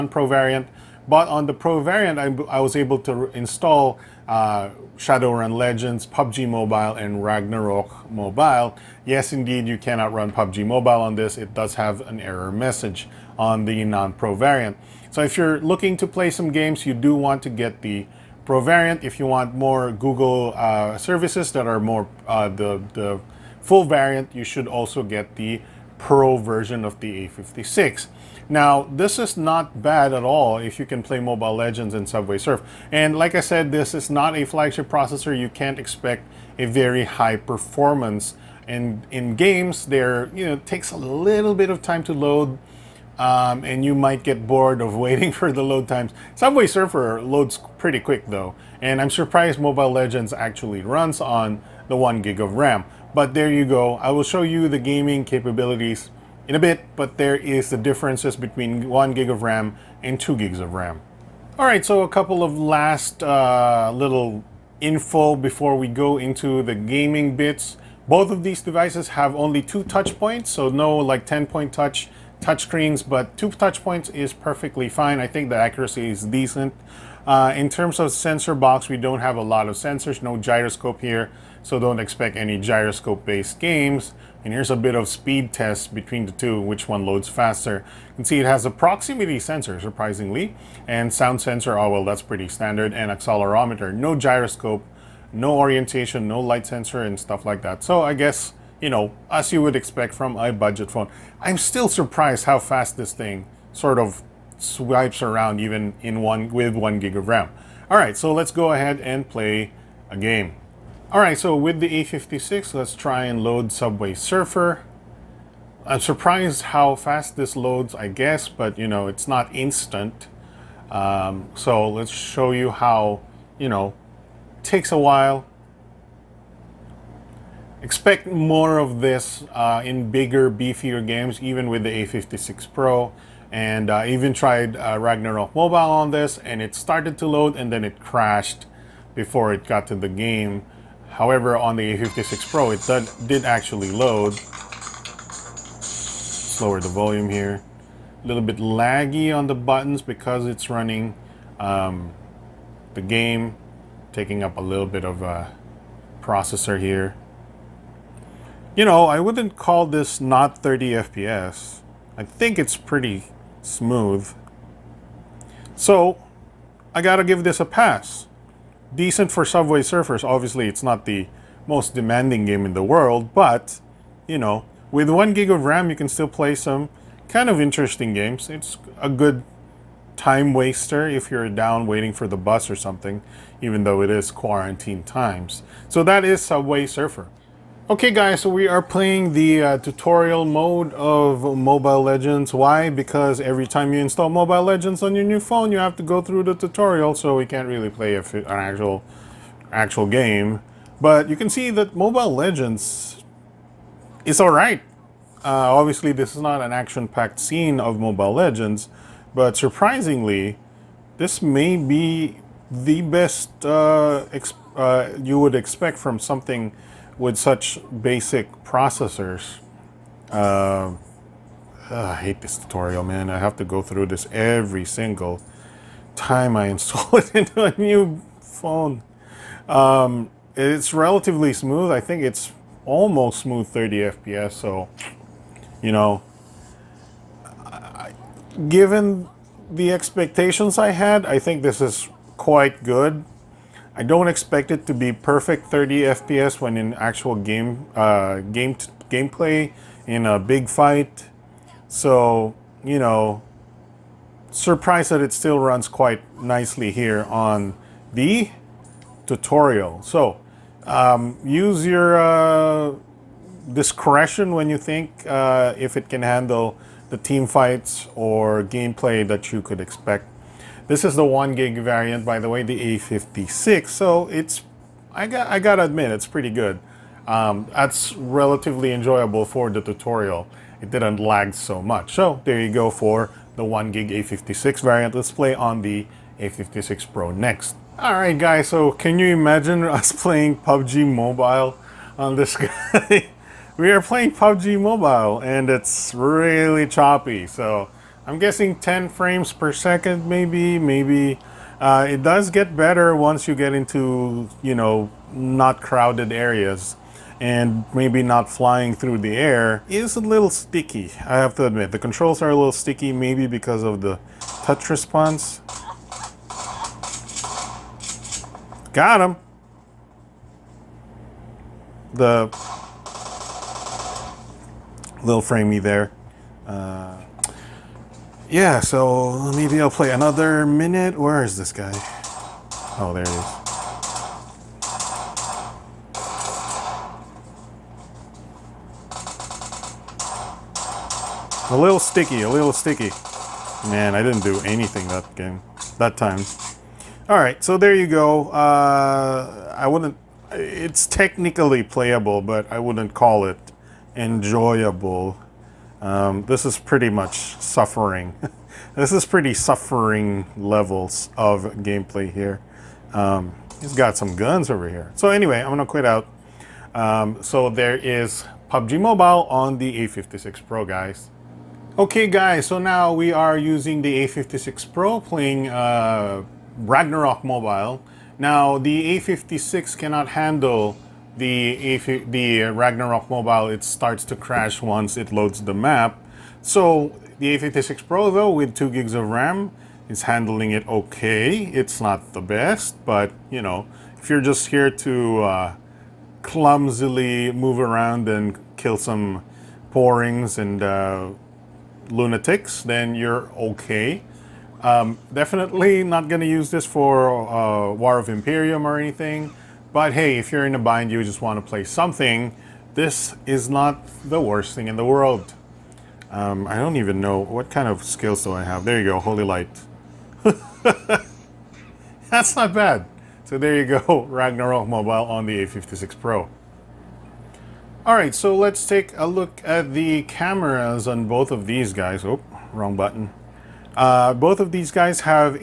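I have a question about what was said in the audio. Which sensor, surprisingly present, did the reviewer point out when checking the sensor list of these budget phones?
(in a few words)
proximity sensor.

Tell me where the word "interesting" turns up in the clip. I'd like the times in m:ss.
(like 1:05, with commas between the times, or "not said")
2:57.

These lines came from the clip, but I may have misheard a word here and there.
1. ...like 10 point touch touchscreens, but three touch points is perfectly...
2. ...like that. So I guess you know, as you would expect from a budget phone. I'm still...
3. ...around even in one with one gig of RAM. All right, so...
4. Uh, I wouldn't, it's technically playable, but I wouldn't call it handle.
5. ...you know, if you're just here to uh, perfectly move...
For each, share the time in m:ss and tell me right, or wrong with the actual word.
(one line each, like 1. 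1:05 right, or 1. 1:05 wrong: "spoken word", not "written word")
1. 1:10 wrong: "two", not "three"
2. 1:37 right
3. 1:45 right
4. 5:48 wrong: "enjoyable", not "handle"
5. 6:33 wrong: "clumsily", not "perfectly".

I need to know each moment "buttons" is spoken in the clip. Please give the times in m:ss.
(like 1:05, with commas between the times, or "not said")
2:29, 7:12.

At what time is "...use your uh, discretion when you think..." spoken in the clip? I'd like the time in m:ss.
4:21.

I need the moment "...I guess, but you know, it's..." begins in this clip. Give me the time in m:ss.
1:57.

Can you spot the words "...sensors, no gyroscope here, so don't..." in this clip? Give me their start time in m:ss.
1:19.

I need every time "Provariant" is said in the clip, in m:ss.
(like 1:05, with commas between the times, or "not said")
0:18.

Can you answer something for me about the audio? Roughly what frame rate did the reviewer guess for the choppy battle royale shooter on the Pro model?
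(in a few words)
10 frames per second.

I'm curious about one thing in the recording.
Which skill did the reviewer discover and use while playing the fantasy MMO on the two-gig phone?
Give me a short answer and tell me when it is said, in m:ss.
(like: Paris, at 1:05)
Holy Light, at 6:59.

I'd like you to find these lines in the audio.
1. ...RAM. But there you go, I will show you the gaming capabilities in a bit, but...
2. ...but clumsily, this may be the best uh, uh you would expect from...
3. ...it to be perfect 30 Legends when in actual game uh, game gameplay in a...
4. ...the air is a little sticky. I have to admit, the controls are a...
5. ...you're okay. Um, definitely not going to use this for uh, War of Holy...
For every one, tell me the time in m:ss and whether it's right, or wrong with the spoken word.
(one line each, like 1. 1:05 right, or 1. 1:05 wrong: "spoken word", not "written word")
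1. 0:52 right
2. 3:29 wrong: "surprisingly", not "clumsily"
3. 4:04 wrong: "FPS", not "Legends"
4. 5:09 right
5. 6:43 wrong: "Emperium", not "Holy".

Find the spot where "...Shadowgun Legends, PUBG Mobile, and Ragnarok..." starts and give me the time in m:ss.
0:04.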